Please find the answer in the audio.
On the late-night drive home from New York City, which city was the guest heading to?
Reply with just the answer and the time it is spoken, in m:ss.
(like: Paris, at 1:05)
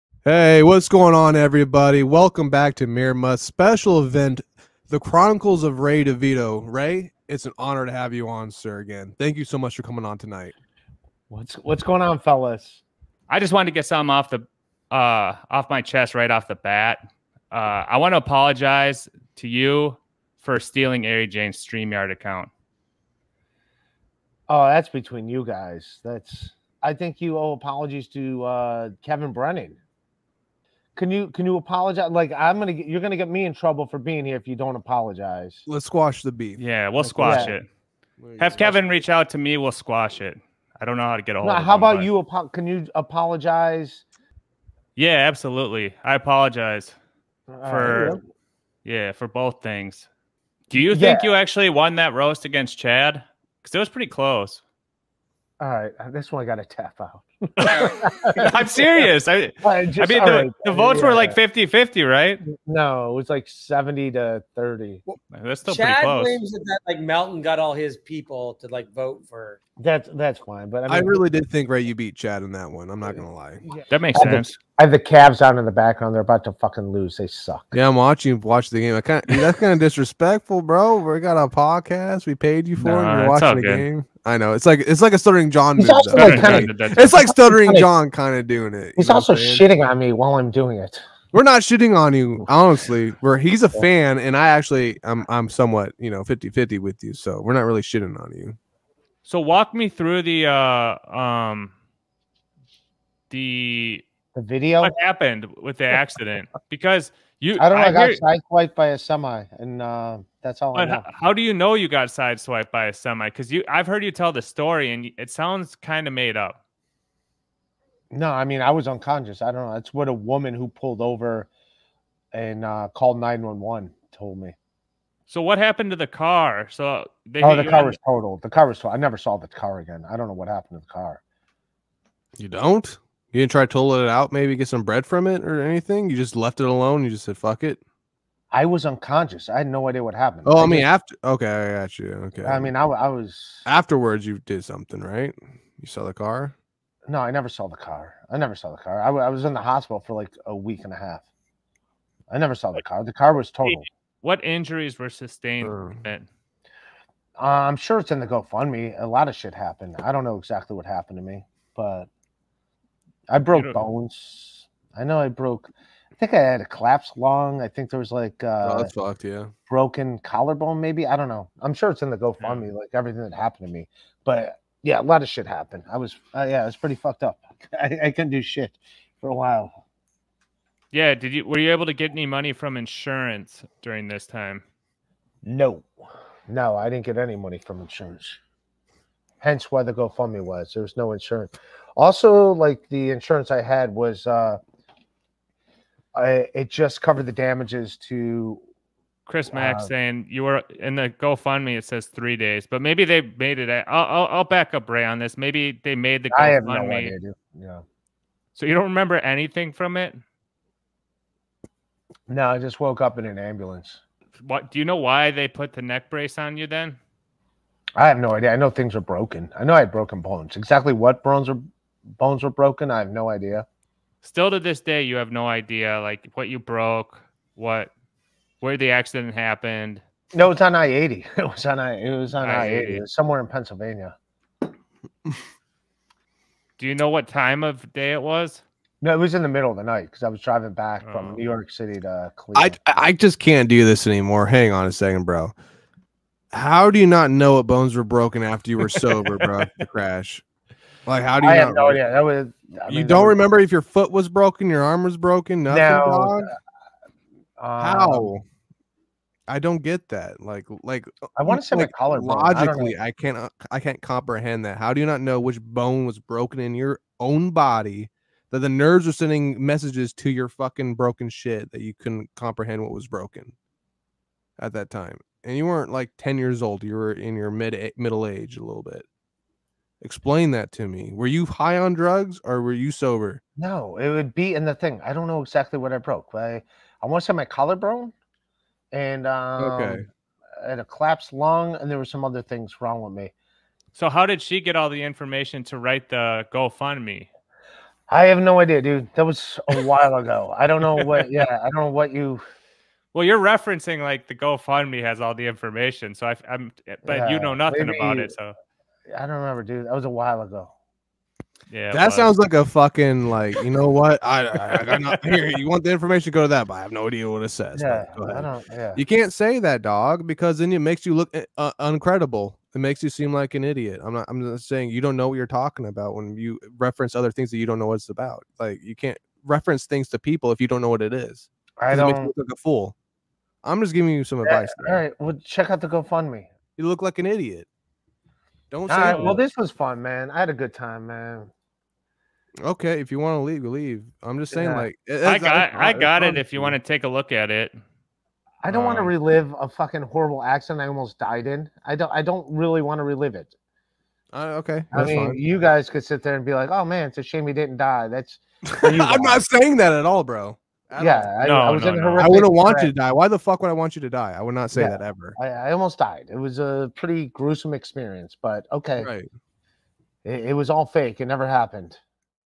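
Cleveland, at 4:02.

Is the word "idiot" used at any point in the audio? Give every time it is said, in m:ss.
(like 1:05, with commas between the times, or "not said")
5:23, 5:37.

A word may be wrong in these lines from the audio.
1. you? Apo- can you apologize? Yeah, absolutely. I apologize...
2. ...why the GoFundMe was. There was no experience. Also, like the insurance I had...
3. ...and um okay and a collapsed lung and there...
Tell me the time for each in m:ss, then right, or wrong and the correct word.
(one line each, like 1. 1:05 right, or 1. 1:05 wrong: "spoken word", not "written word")
1. 0:42 right
2. 3:09 wrong: "insurance", not "experience"
3. 4:48 right.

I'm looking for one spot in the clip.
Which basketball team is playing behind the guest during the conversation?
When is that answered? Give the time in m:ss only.
1:14.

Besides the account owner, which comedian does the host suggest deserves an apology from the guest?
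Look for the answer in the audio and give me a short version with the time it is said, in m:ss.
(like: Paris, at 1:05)
Kevin Brennan, at 0:29.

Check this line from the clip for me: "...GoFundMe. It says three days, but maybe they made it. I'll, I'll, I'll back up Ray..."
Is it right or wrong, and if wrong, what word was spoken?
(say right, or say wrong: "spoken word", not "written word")
right.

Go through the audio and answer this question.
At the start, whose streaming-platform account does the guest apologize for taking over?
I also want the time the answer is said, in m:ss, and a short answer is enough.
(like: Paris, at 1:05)
Ari Jane, at 0:21.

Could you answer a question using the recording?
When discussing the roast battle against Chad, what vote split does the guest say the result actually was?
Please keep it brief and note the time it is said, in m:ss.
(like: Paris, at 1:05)
70 to 30, at 1:03.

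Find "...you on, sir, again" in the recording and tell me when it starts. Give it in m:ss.
0:08.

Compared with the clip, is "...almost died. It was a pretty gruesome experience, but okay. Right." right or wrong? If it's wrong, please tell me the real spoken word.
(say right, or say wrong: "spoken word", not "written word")
right.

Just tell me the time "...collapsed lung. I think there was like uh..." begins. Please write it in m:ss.
2:46.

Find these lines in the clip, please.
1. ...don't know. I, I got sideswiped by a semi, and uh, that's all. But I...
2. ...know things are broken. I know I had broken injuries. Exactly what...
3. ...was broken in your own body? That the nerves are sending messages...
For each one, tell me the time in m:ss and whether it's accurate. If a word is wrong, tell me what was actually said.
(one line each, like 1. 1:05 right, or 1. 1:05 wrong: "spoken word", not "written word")
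1. 1:47 right
2. 3:38 wrong: "bones", not "injuries"
3. 4:26 right.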